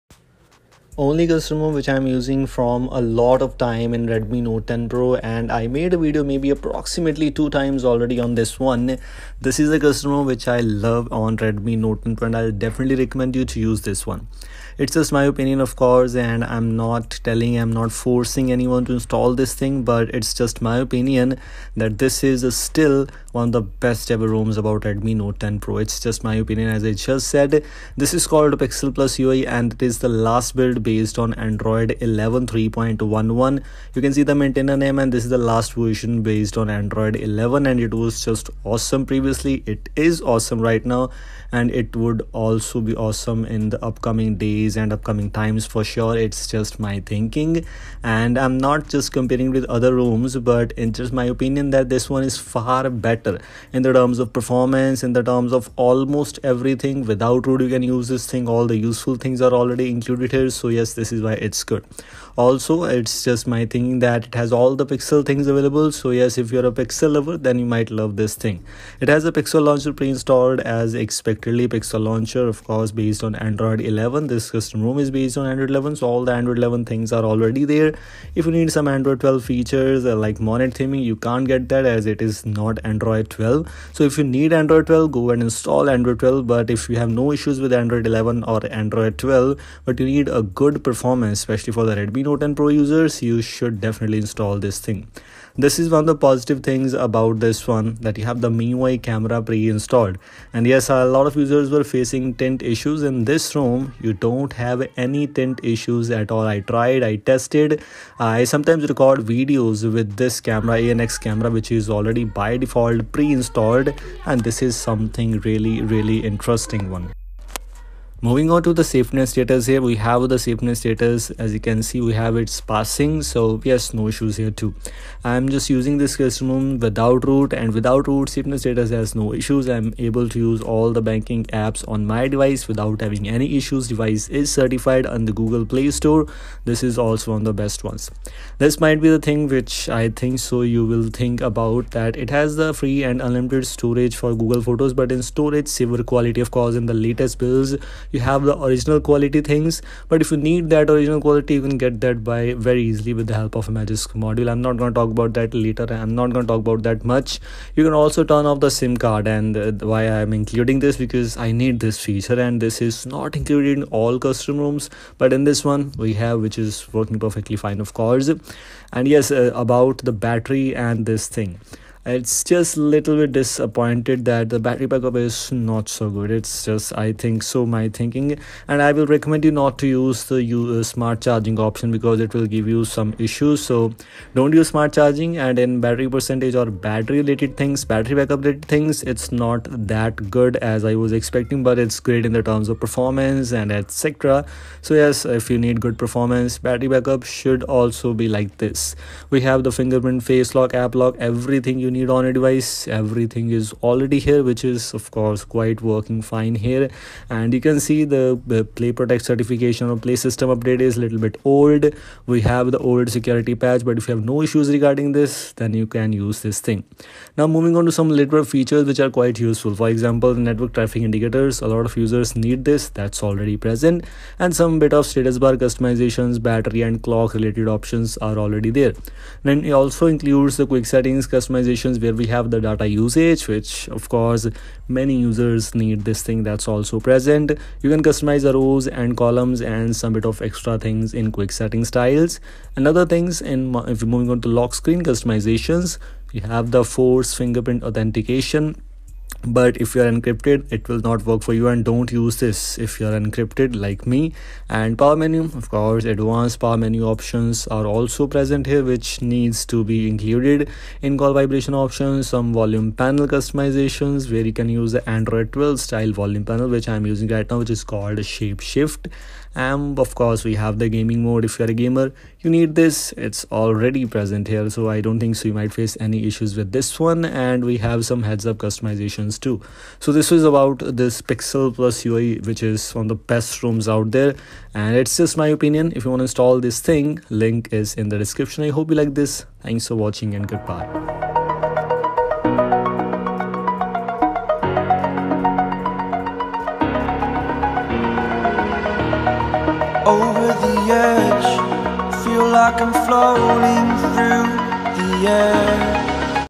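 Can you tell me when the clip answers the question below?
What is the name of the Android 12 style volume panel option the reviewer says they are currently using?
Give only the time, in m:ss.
4:28.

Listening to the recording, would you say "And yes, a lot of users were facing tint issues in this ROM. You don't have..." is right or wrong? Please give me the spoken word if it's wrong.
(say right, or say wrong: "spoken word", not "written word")
right.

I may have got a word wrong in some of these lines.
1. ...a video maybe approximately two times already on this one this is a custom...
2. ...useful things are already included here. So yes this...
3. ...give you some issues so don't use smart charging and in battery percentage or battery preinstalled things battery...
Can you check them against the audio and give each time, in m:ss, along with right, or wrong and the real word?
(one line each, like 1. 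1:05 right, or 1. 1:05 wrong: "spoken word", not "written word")
1. 0:05 right
2. 0:58 right
3. 3:02 wrong: "related", not "preinstalled".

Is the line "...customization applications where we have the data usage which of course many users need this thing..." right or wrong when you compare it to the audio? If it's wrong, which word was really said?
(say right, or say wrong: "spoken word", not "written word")
right.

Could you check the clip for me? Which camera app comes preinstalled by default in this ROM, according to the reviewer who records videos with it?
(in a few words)
ANX camera.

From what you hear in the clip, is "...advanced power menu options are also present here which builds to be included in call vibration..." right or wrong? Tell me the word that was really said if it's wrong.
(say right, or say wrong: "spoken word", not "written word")
wrong: "needs", not "builds".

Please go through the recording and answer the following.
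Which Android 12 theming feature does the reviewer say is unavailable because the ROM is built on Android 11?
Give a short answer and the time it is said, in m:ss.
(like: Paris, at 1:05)
Monet theming, at 1:20.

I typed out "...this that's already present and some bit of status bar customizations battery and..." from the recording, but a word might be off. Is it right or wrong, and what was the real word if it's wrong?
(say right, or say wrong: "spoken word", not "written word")
right.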